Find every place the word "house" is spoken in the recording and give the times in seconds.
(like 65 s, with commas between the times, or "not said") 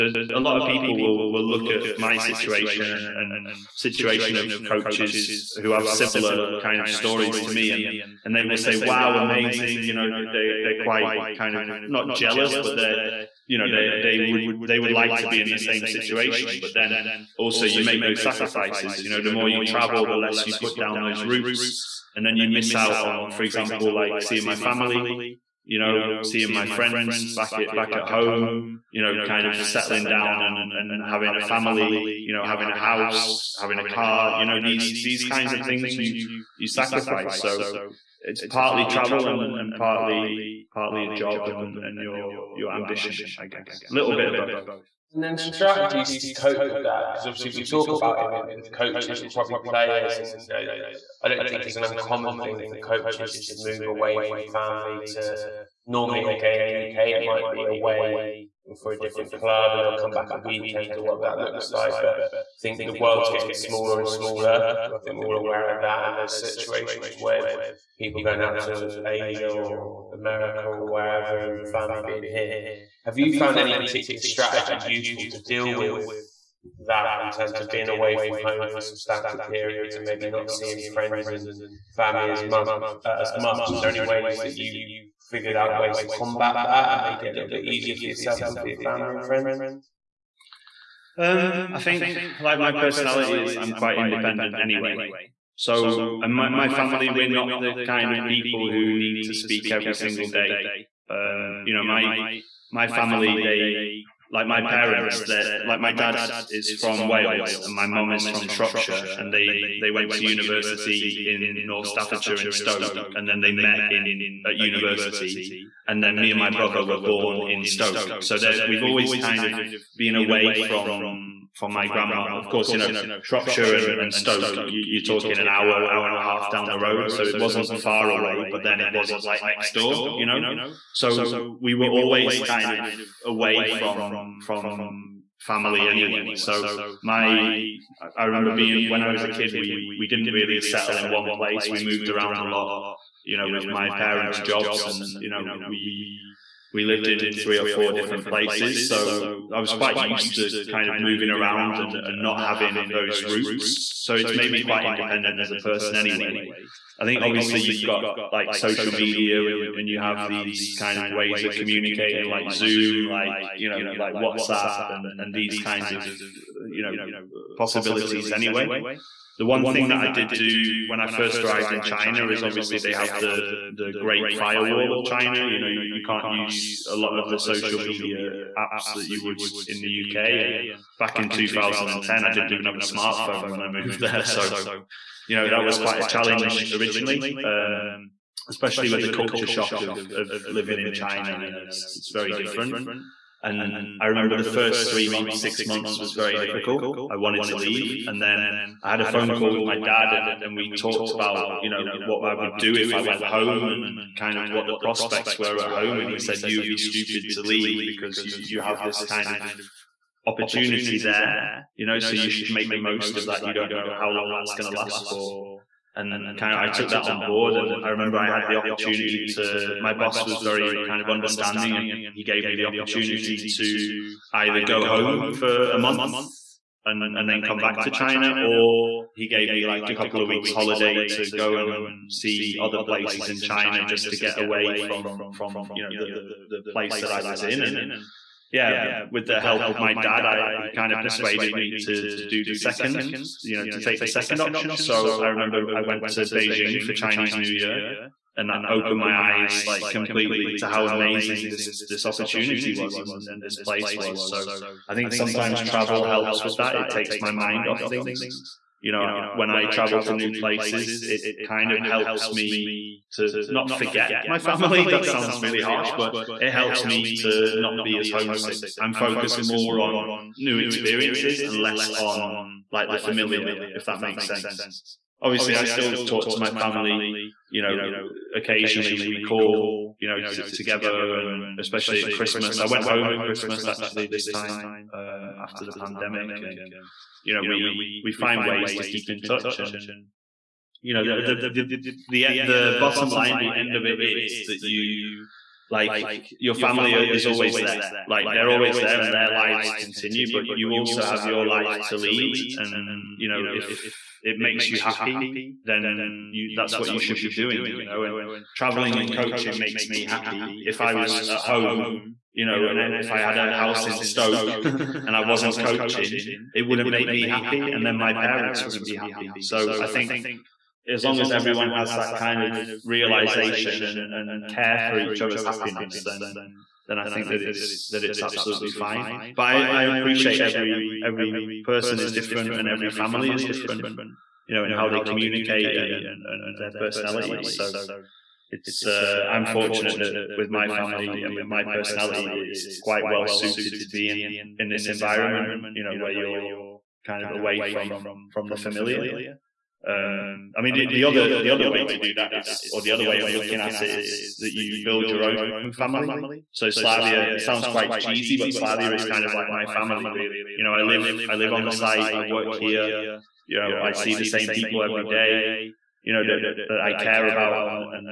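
32 s, 313 s.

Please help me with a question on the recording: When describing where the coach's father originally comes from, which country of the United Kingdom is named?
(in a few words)
Wales.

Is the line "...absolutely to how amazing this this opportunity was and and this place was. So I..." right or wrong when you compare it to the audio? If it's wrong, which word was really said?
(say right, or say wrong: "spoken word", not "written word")
wrong: "completely", not "absolutely".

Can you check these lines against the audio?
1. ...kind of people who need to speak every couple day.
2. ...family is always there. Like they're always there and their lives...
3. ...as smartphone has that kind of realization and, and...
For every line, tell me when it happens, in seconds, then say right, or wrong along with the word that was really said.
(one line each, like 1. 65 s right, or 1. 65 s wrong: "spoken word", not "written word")
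1. 97 s wrong: "single", not "couple"
2. 296 s right
3. 321 s wrong: "everyone", not "smartphone".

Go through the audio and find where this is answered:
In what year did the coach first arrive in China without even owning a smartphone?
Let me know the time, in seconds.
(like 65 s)
181 s.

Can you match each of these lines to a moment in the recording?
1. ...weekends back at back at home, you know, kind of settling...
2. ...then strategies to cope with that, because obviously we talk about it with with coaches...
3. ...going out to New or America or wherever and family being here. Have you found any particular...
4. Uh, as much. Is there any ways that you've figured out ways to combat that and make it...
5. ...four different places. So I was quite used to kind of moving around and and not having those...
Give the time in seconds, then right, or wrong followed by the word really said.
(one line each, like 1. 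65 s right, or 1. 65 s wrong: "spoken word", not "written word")
1. 26 s wrong: "friends", not "weekends"
2. 45 s right
3. 68 s wrong: "Asia", not "New"
4. 83 s right
5. 147 s right.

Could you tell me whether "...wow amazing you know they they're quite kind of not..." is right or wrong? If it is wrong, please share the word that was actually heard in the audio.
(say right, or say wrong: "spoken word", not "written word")
right.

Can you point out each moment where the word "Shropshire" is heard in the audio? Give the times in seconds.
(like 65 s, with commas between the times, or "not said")
108 s, 123 s.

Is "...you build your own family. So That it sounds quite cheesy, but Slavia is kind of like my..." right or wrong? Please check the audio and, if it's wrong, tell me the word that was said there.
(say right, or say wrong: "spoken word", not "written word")
wrong: "Slavia", not "That".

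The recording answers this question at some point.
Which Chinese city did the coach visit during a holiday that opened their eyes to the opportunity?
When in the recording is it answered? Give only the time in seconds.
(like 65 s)
246 s.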